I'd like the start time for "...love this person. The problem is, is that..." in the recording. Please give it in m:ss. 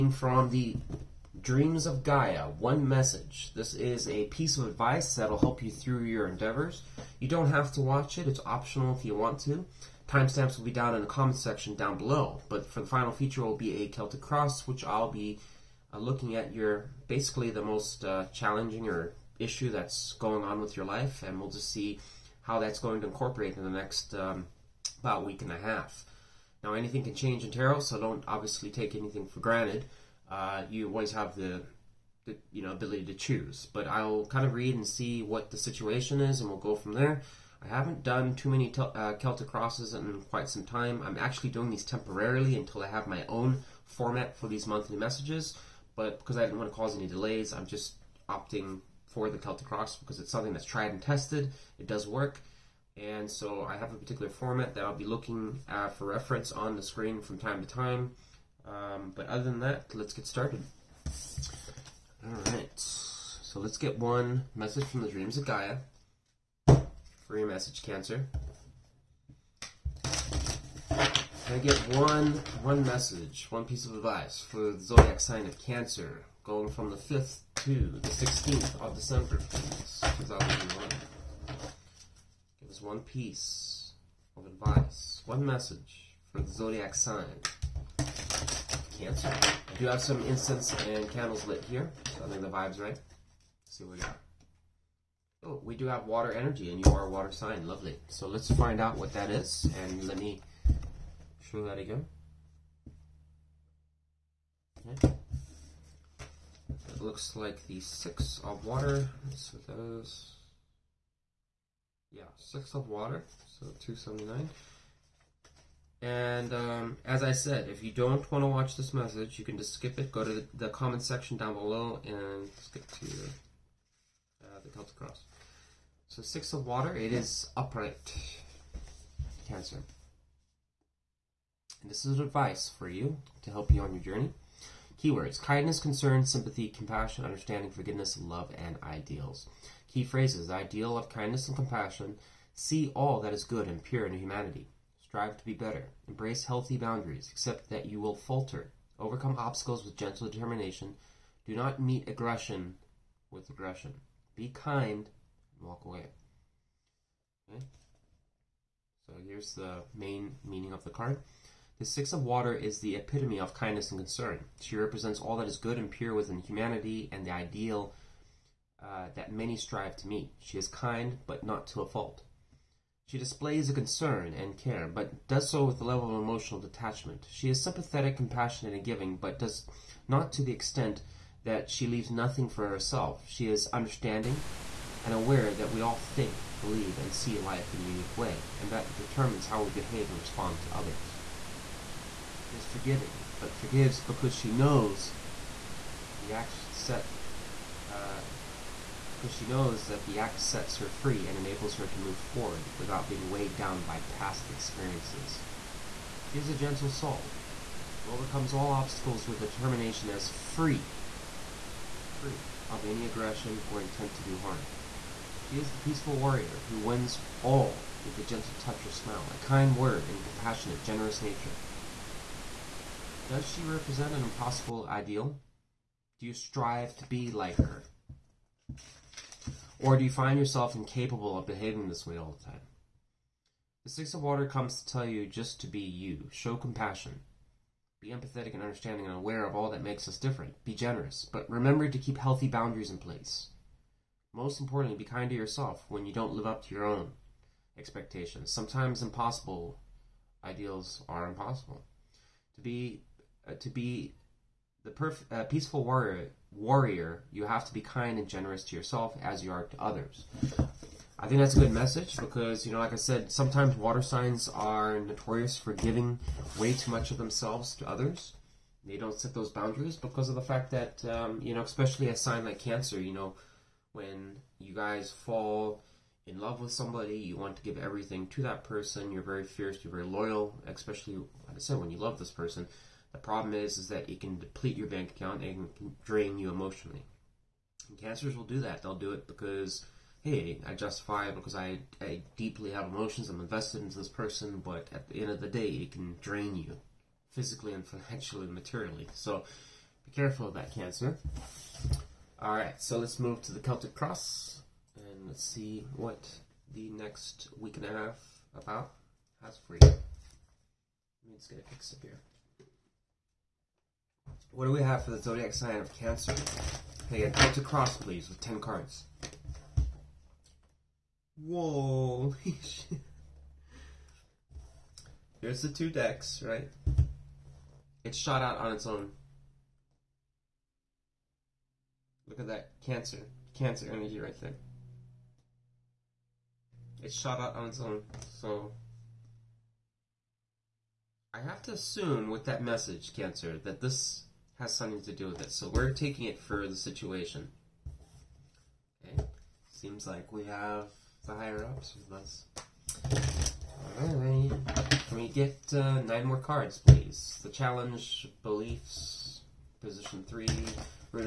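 4:41.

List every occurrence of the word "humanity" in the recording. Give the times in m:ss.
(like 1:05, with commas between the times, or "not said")
2:24, 2:46.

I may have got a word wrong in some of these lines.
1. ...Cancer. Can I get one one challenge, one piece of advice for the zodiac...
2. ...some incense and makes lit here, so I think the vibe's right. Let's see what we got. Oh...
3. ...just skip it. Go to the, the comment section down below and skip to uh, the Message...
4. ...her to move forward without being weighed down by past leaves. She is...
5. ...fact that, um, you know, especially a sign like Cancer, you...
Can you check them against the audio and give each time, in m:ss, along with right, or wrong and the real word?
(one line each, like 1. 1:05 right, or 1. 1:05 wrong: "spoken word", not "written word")
1. 1:07 wrong: "message", not "challenge"
2. 1:30 wrong: "candles", not "makes"
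3. 1:59 wrong: "Celtic", not "Message"
4. 3:21 wrong: "experiences", not "leaves"
5. 4:30 right.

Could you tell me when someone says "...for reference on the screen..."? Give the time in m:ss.
0:55.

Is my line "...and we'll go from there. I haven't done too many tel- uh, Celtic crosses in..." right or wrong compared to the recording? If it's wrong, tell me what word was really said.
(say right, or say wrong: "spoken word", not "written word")
right.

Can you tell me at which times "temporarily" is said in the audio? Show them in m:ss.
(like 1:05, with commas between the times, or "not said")
0:41.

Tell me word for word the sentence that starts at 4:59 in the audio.
So be careful of that, Cancer.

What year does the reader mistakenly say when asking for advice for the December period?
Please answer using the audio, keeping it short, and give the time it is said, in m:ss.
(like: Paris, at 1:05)
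2001, at 1:20.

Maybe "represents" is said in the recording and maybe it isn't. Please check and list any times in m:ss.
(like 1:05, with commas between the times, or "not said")
2:44, 3:43.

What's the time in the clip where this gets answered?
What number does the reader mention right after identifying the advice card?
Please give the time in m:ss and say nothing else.
1:53.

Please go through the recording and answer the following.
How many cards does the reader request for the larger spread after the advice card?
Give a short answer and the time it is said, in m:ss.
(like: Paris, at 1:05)
10, at 5:18.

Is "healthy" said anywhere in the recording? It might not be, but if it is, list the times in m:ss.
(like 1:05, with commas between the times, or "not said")
2:26, 4:02.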